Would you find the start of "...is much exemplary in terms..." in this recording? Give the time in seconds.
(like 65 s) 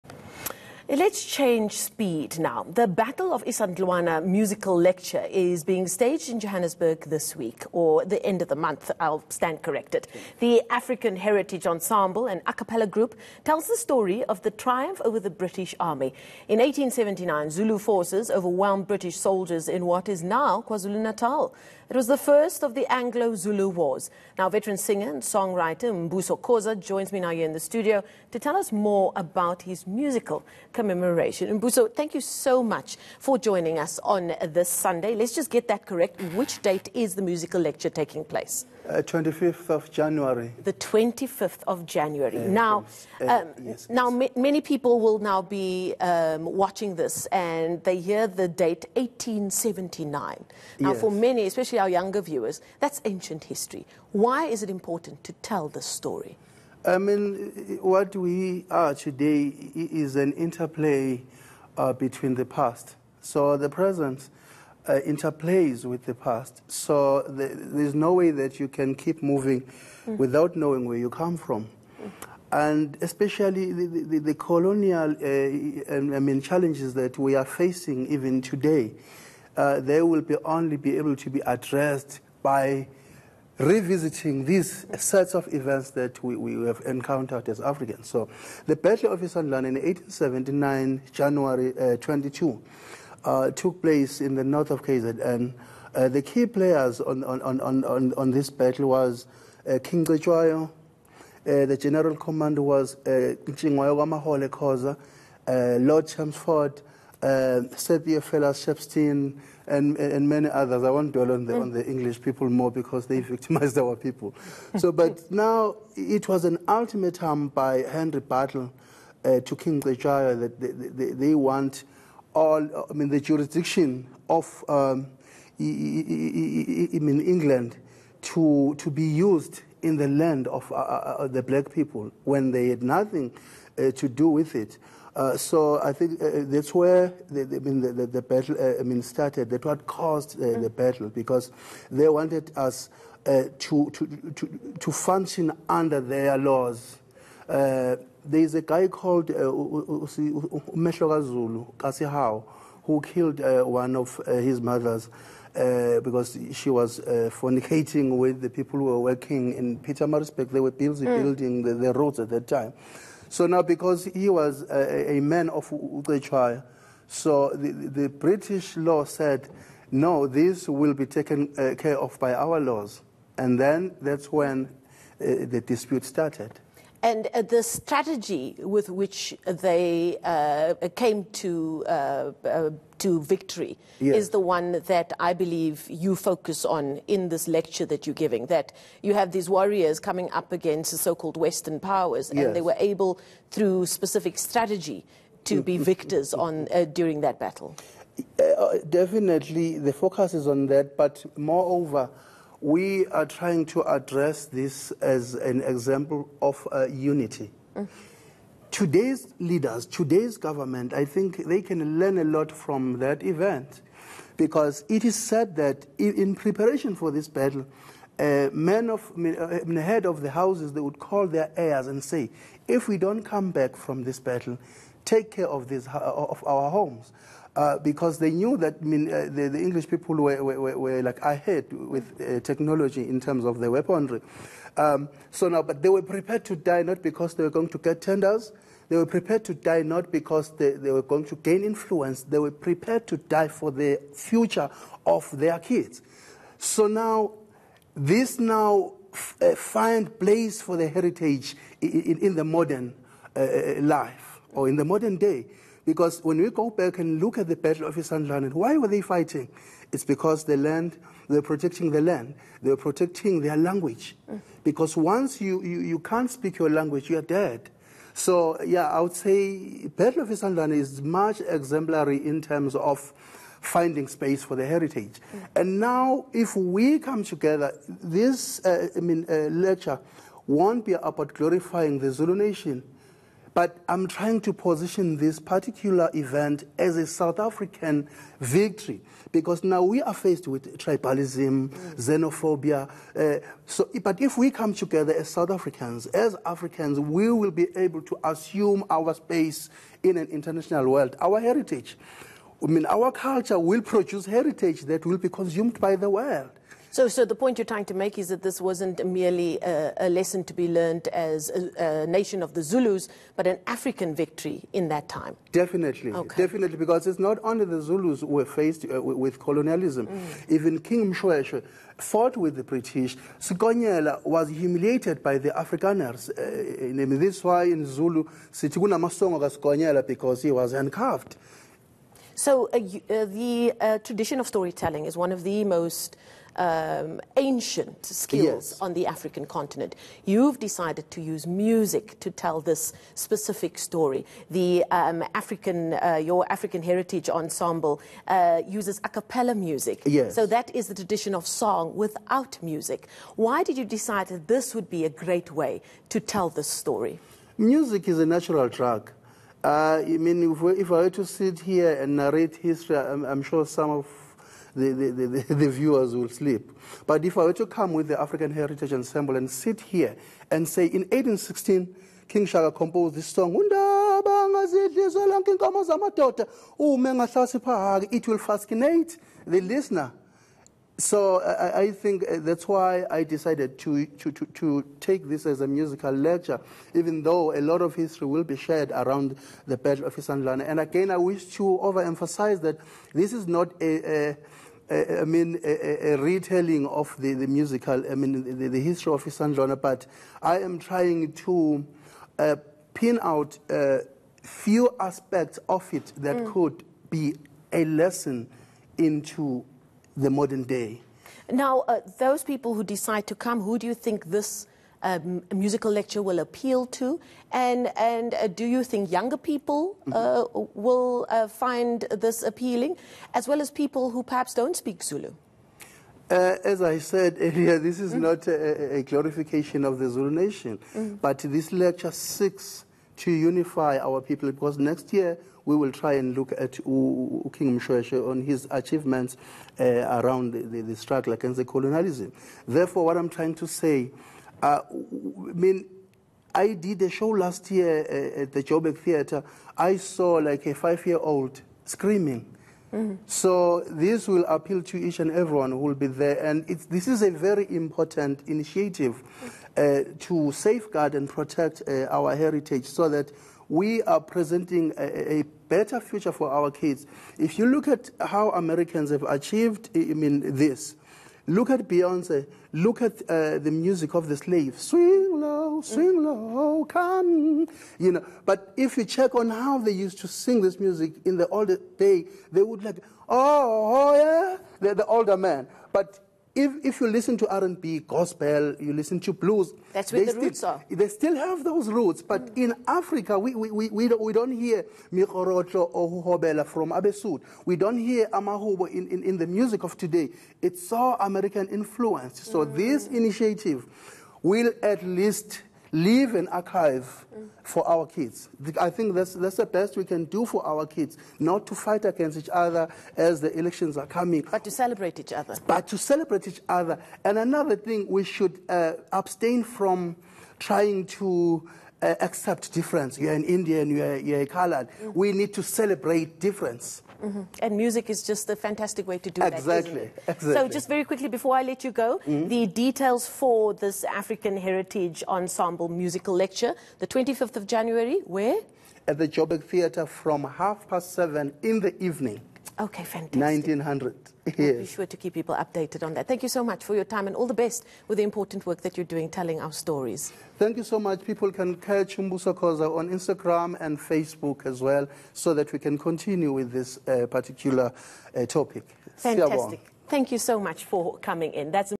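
270 s.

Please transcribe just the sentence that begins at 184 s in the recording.
is the one that I believe you focus on in this lecture that you're giving.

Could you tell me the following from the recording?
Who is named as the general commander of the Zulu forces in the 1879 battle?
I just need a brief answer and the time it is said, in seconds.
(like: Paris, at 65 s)
Ntshingwayo Wamahole Khoza, at 103 s.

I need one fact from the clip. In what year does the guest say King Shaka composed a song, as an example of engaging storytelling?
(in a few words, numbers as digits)
1816.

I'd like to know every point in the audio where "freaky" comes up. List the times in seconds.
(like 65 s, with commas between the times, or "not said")
not said.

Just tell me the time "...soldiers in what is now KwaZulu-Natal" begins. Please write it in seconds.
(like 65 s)
19 s.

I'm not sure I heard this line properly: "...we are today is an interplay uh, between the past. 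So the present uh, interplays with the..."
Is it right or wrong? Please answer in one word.
right.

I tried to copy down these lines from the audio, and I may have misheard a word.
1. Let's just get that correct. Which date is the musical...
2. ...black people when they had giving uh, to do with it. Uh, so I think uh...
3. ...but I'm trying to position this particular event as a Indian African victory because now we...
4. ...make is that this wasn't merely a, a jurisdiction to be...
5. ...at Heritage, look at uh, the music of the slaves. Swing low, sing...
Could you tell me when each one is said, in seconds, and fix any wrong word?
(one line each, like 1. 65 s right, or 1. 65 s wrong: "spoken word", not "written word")
1. 35 s right
2. 131 s wrong: "nothing", not "giving"
3. 283 s wrong: "South", not "Indian"
4. 307 s wrong: "lesson", not "jurisdiction"
5. 471 s wrong: "Beyonce", not "Heritage".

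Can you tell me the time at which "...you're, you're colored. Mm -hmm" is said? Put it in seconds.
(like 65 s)
523 s.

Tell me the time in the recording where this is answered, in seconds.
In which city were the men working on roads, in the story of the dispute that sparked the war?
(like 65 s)
159 s.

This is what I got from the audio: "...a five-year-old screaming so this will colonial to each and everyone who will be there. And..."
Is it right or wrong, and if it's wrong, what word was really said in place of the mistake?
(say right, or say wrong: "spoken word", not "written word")
wrong: "appeal", not "colonial".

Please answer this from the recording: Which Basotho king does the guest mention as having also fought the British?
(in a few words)
King Mshweshwe.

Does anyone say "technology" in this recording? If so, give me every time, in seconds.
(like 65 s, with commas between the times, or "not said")
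232 s.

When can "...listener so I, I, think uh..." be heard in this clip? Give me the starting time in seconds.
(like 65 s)
379 s.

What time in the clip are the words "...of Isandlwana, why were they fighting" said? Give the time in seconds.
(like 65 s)
257 s.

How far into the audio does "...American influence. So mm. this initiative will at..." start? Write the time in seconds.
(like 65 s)
501 s.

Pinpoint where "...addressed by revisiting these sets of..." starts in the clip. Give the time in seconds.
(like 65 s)
81 s.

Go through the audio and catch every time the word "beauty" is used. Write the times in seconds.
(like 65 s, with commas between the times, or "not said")
not said.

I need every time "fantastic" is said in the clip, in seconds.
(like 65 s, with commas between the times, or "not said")
528 s, 543 s, 559 s.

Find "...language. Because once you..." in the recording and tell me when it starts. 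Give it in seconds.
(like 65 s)
263 s.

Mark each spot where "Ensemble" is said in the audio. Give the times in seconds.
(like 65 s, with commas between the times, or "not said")
11 s, 347 s, 368 s, 535 s.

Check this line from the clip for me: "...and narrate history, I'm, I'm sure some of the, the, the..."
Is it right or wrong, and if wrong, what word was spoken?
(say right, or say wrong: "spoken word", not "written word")
right.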